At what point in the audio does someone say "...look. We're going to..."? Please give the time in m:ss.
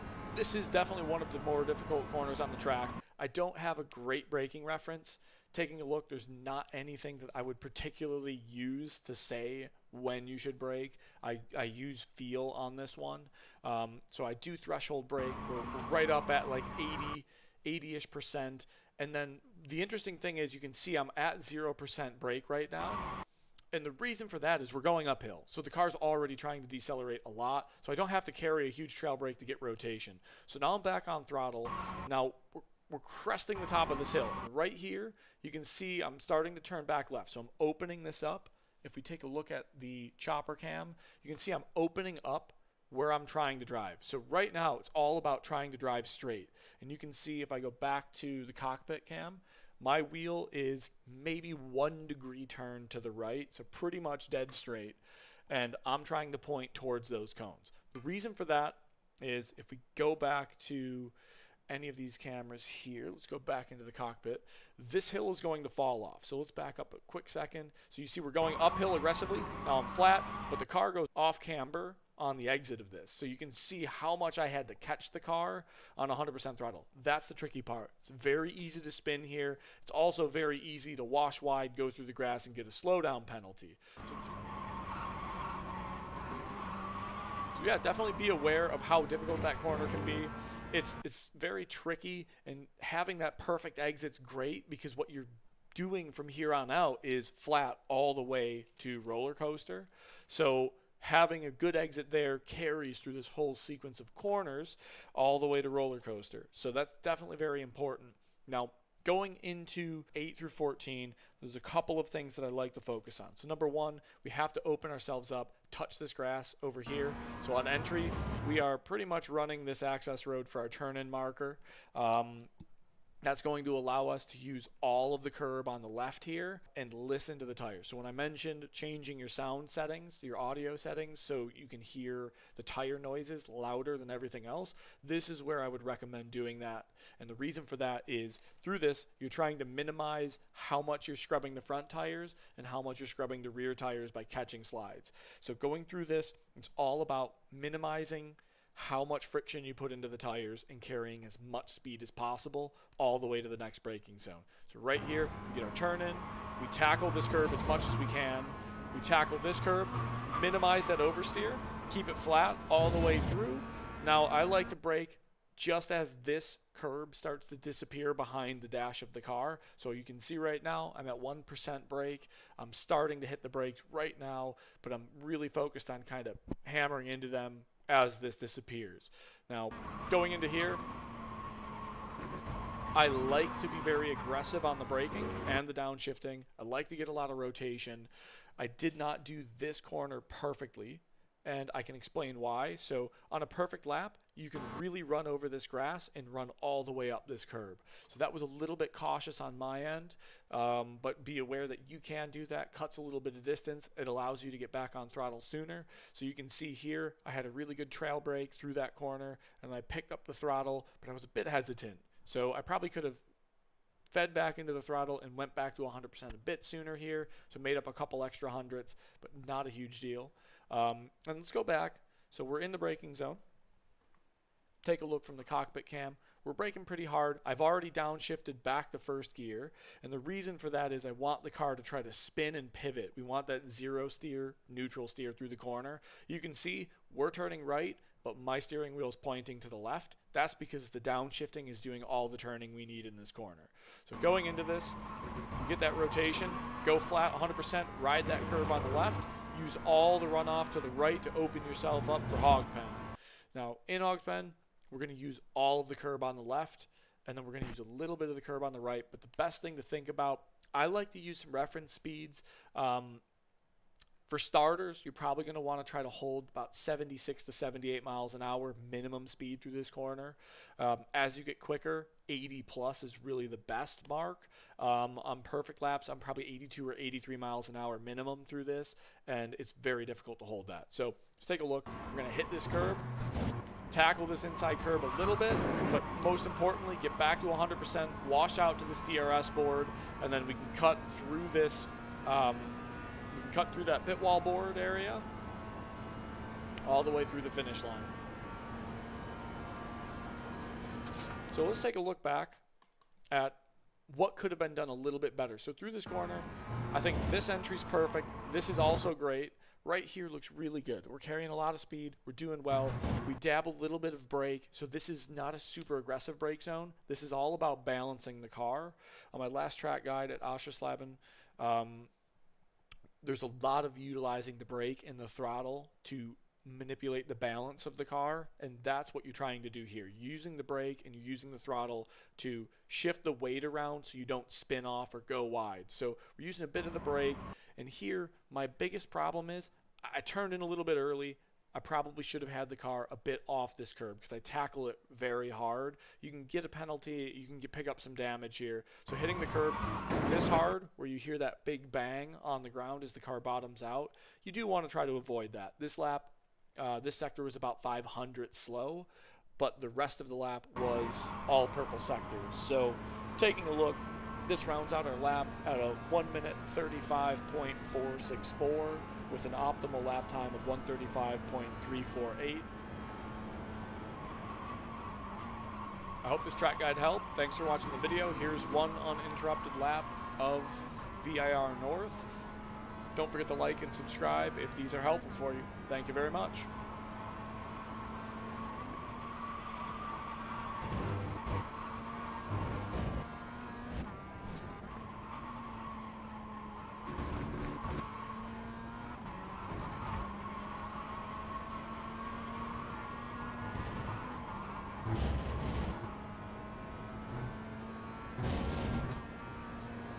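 4:41.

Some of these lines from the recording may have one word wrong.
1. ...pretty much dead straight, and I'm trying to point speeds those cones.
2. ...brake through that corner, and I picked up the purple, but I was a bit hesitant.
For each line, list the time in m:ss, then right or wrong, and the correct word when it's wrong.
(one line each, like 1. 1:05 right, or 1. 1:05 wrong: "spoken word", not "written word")
1. 0:53 wrong: "towards", not "speeds"
2. 3:28 wrong: "throttle", not "purple".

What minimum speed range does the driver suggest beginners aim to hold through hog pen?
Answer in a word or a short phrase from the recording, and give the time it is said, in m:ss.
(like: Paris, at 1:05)
76 to 78 mph, at 4:26.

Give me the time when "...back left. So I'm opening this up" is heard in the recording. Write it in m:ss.
0:36.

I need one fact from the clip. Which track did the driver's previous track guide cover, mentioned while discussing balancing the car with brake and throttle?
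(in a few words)
Oschersleben.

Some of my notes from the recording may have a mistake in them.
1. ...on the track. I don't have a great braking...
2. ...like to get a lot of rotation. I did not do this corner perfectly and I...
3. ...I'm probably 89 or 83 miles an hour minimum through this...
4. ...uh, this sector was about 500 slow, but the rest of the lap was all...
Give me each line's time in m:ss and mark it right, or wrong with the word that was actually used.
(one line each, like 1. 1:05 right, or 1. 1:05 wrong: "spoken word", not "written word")
1. 0:02 right
2. 3:06 right
3. 4:36 wrong: "82", not "89"
4. 5:56 right.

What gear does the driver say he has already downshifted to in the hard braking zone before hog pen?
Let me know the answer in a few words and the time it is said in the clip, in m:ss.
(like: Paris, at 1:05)
First gear, at 3:48.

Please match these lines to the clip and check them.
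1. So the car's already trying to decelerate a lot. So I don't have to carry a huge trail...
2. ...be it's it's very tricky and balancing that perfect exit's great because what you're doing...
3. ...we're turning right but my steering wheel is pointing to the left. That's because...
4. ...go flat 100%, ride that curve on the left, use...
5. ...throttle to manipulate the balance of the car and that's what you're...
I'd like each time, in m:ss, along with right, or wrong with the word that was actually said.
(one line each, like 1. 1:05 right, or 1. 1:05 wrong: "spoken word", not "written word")
1. 0:25 right
2. 1:30 wrong: "having", not "balancing"
3. 3:57 right
4. 4:06 right
5. 5:25 right.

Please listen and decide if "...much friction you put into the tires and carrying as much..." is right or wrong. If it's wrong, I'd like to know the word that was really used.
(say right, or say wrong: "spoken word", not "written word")
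right.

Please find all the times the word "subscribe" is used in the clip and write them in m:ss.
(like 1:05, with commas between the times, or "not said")
6:23.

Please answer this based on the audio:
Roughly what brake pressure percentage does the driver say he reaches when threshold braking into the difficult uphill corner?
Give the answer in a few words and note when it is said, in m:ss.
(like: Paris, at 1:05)
80%, at 0:17.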